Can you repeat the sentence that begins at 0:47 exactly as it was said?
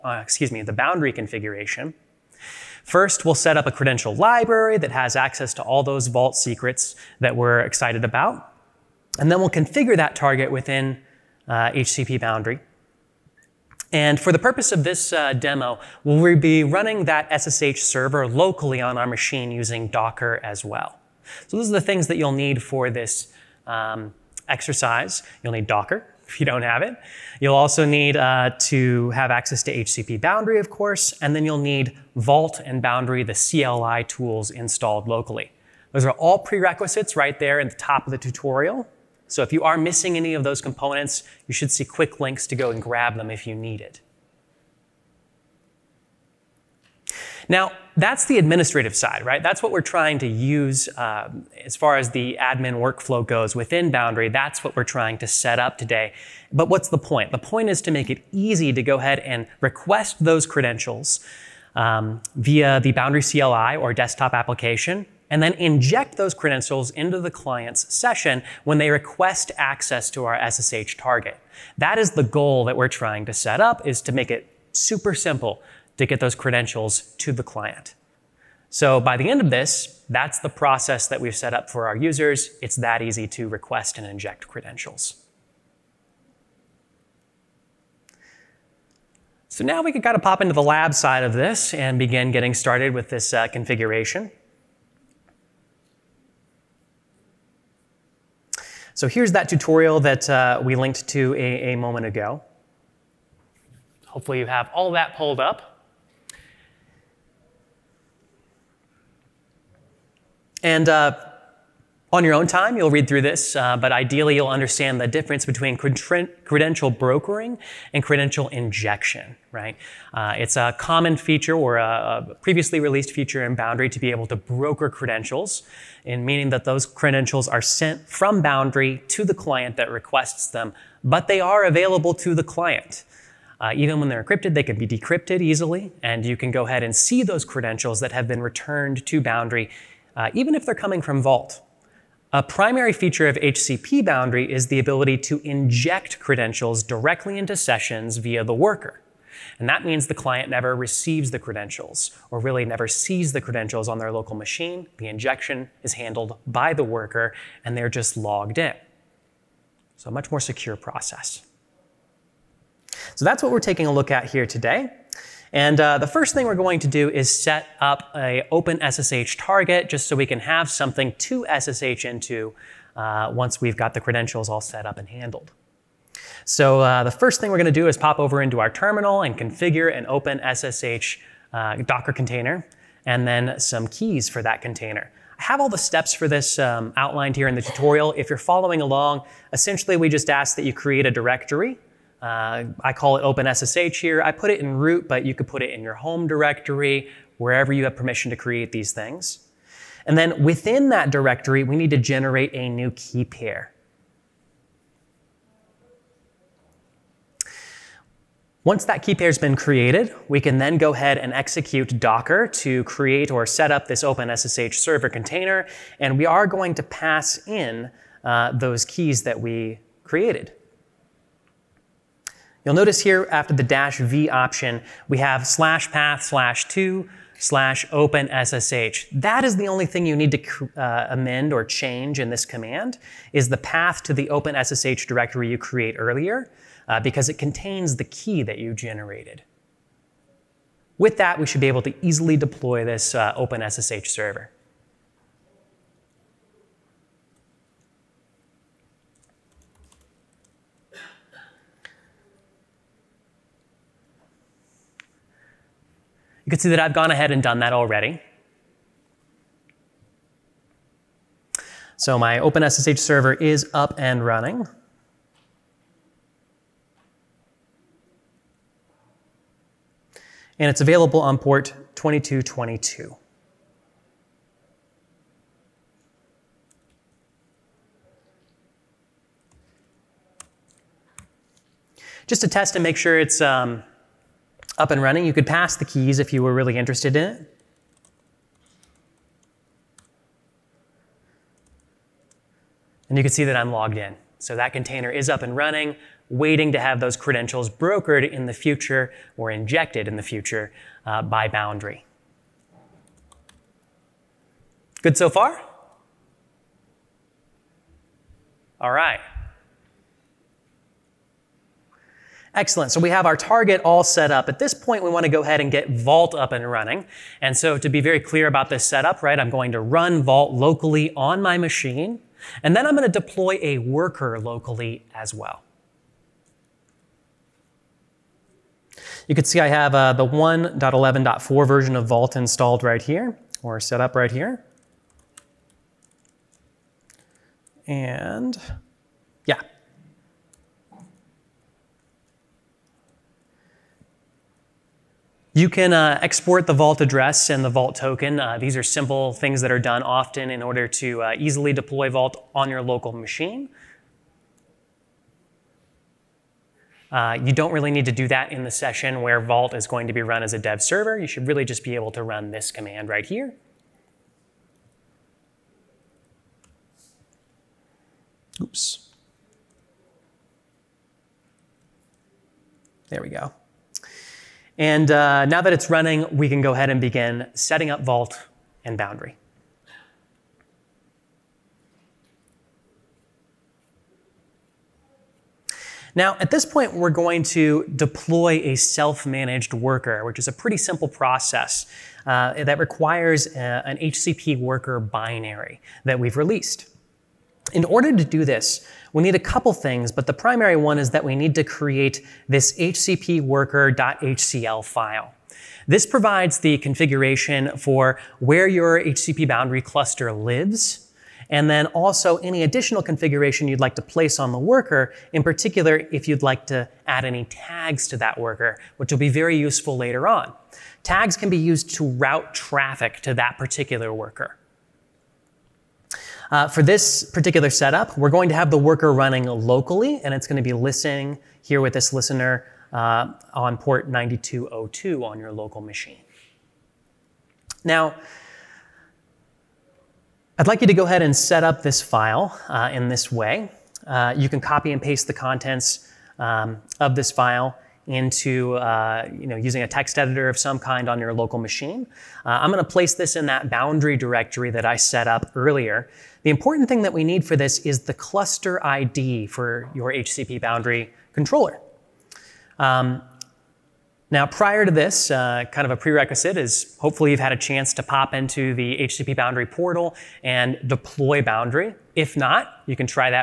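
Now, that's the administrative side, right?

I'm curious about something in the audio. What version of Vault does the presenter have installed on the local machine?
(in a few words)
1.11.4.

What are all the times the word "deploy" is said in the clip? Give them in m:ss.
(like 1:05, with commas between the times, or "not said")
4:02, 5:23, 5:51, 6:27, 7:50.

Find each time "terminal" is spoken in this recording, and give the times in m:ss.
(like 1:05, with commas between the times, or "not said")
2:58.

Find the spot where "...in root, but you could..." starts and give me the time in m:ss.
3:14.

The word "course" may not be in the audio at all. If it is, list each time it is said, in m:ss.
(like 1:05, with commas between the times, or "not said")
0:30.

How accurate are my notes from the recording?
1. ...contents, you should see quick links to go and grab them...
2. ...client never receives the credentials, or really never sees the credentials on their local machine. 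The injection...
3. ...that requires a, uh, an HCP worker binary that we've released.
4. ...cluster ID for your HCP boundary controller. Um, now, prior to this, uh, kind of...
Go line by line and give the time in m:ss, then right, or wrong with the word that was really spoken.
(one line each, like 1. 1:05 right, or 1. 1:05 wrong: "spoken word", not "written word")
1. 0:40 wrong: "components", not "contents"
2. 2:30 right
3. 6:32 right
4. 7:38 right.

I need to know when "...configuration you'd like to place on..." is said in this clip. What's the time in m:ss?
6:53.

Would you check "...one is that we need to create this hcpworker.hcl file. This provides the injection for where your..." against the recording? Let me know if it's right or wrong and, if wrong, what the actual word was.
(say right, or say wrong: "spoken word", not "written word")
wrong: "configuration", not "injection".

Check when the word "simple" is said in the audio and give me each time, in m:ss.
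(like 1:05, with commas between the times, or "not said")
1:15, 5:48, 6:30.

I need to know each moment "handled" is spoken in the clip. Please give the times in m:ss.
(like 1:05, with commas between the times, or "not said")
2:35, 2:55.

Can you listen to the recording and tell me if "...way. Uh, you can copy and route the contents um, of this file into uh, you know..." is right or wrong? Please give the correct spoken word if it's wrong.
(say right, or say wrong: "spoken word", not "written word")
wrong: "paste", not "route".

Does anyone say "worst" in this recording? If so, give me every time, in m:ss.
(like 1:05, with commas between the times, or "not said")
not said.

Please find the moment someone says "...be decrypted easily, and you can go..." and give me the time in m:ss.
2:14.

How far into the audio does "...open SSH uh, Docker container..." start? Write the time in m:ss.
3:00.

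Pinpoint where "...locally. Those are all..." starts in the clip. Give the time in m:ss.
0:35.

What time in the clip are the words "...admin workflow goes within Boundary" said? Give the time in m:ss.
0:52.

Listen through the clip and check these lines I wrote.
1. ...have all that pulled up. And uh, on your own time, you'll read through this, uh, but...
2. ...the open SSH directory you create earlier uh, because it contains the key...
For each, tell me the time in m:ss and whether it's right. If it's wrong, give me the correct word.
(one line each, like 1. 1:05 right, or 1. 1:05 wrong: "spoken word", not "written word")
1. 1:44 right
2. 3:54 right.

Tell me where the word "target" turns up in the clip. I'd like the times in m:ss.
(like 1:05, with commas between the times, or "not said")
0:10, 1:10, 2:49, 5:13.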